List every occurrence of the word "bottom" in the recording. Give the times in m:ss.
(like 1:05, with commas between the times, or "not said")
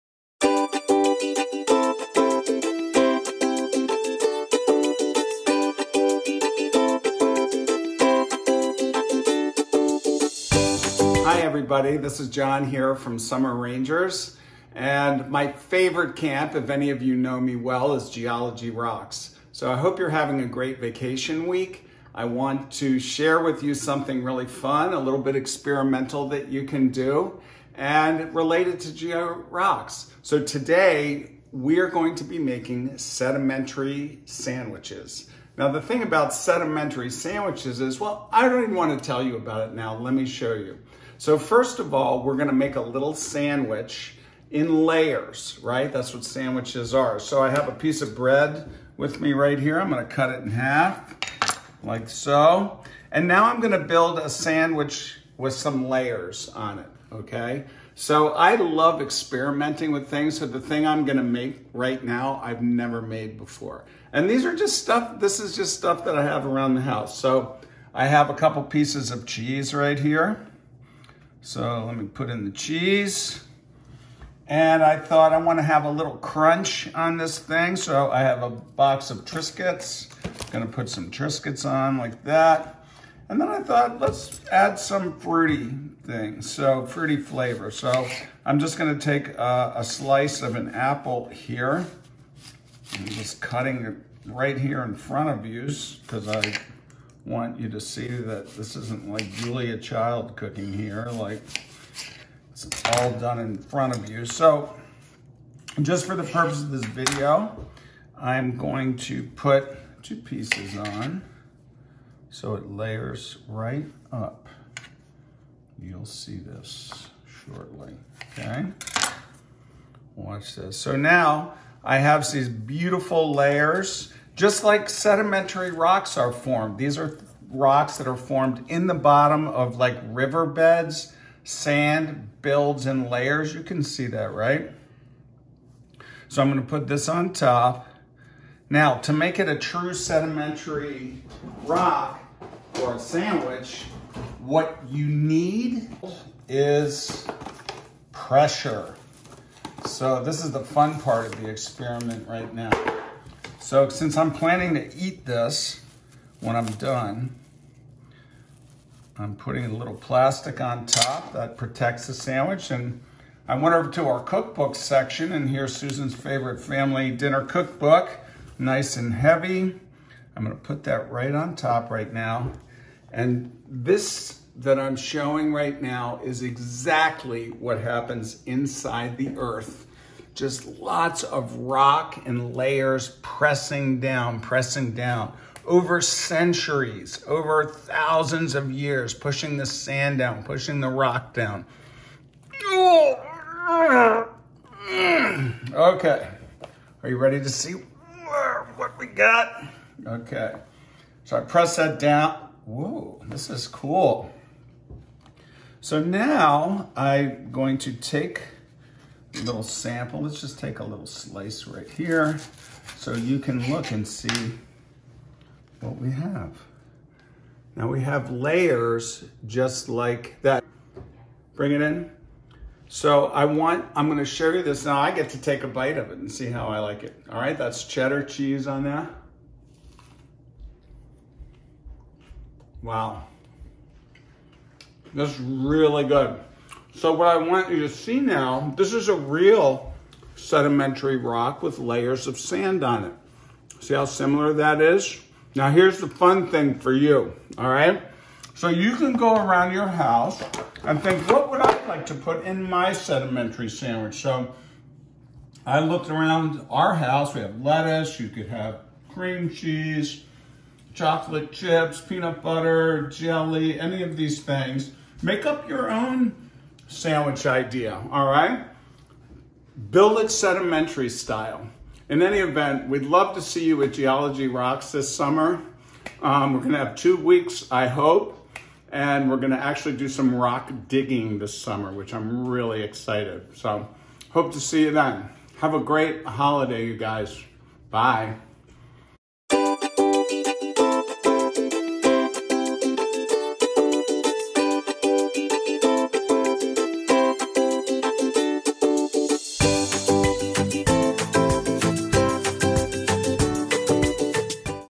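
2:08.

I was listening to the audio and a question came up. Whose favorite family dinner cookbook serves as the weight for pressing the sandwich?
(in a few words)
Susan.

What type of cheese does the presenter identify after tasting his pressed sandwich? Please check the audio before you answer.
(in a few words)
Cheddar.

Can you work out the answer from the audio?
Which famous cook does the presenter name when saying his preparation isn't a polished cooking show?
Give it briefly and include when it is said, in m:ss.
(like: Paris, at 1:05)
Julia Child, at 1:39.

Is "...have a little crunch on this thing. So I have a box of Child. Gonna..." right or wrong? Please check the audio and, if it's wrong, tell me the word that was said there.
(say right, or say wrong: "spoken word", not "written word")
wrong: "Triscuits", not "Child".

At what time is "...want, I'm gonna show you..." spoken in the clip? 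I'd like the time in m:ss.
3:43.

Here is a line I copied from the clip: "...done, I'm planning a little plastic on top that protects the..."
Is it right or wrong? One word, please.
wrong.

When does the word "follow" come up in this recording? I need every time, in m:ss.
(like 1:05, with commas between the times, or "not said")
not said.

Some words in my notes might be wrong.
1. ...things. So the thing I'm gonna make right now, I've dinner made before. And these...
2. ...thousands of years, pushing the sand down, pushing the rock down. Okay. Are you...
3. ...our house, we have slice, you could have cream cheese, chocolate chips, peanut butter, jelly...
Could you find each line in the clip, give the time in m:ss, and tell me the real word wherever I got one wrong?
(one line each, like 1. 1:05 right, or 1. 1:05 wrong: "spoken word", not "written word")
1. 1:00 wrong: "never", not "dinner"
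2. 3:07 right
3. 4:16 wrong: "lettuce", not "slice".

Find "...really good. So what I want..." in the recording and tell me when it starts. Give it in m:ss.
3:55.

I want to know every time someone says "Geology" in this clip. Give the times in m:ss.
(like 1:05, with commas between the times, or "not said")
0:18, 4:33.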